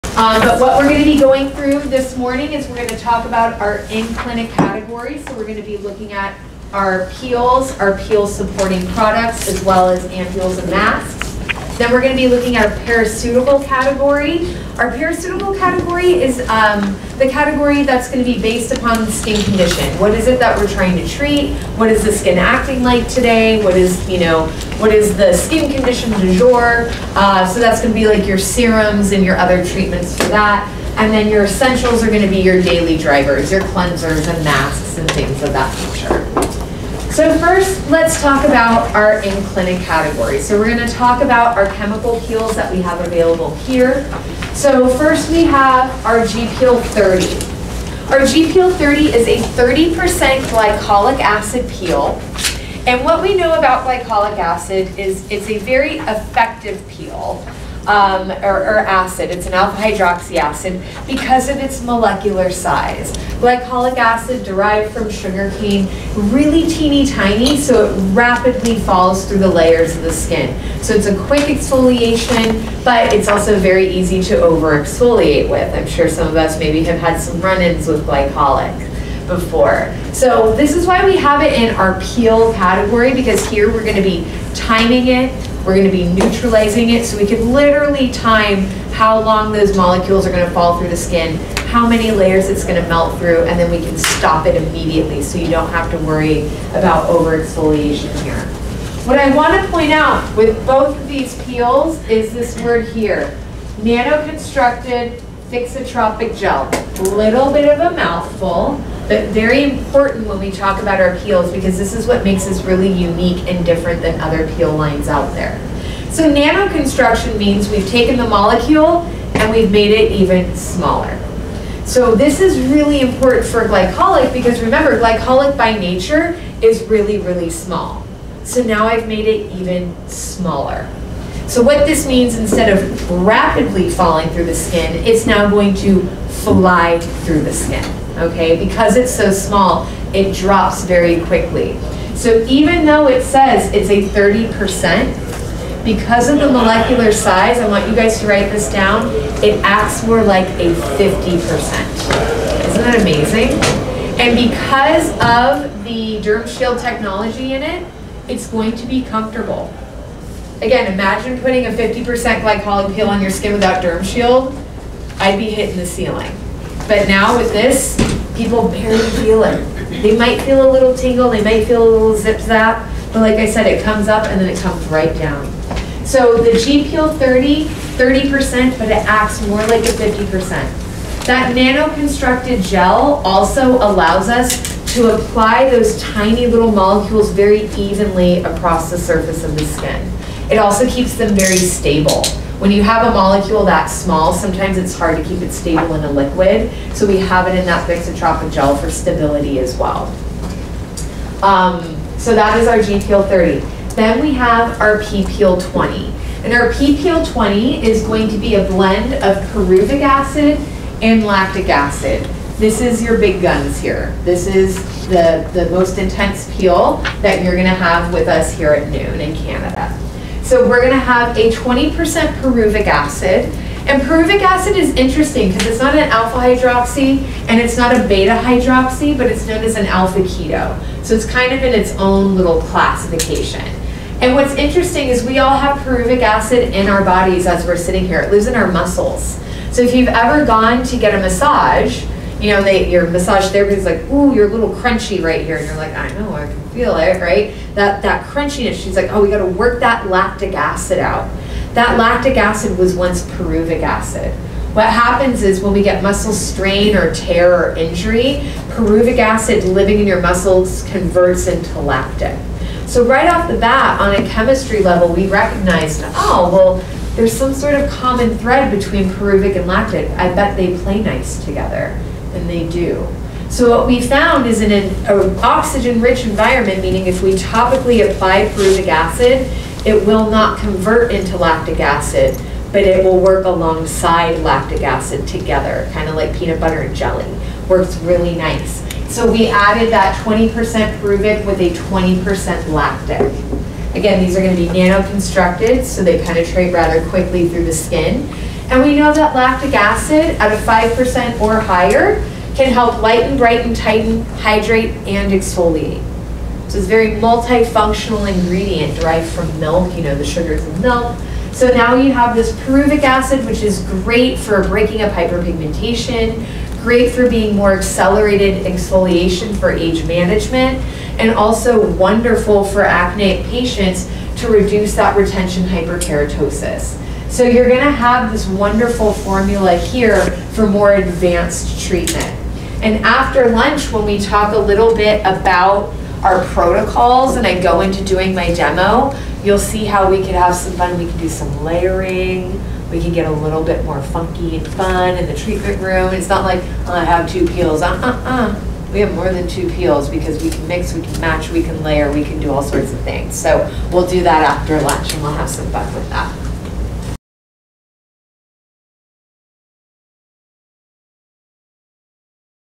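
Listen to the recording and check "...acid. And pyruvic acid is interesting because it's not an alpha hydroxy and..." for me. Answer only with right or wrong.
right.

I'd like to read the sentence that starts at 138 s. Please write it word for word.
Because it's so small, it drops very quickly.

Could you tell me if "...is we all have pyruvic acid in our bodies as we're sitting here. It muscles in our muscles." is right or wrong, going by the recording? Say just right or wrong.
wrong.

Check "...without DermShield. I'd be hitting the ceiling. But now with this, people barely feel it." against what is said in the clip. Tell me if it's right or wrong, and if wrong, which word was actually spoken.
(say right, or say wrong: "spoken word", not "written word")
right.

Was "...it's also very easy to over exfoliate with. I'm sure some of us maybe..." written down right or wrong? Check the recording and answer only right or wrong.
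right.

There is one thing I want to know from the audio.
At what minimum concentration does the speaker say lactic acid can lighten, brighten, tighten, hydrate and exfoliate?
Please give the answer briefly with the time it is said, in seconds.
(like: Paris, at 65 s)
5%, at 300 s.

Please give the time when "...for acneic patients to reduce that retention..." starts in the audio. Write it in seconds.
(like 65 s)
322 s.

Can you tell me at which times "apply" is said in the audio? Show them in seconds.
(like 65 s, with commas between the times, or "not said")
185 s, 278 s.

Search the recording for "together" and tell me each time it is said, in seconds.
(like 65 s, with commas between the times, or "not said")
271 s, 285 s.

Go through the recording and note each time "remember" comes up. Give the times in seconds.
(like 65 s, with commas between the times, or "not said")
124 s.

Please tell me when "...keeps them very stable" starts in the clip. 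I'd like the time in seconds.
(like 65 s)
190 s.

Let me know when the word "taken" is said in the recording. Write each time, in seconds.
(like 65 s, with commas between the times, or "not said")
117 s.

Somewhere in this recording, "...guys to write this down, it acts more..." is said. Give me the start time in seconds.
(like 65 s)
147 s.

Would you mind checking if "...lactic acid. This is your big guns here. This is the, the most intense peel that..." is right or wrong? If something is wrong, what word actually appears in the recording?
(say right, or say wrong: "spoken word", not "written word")
right.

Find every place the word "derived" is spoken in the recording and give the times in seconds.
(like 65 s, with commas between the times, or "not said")
64 s, 308 s.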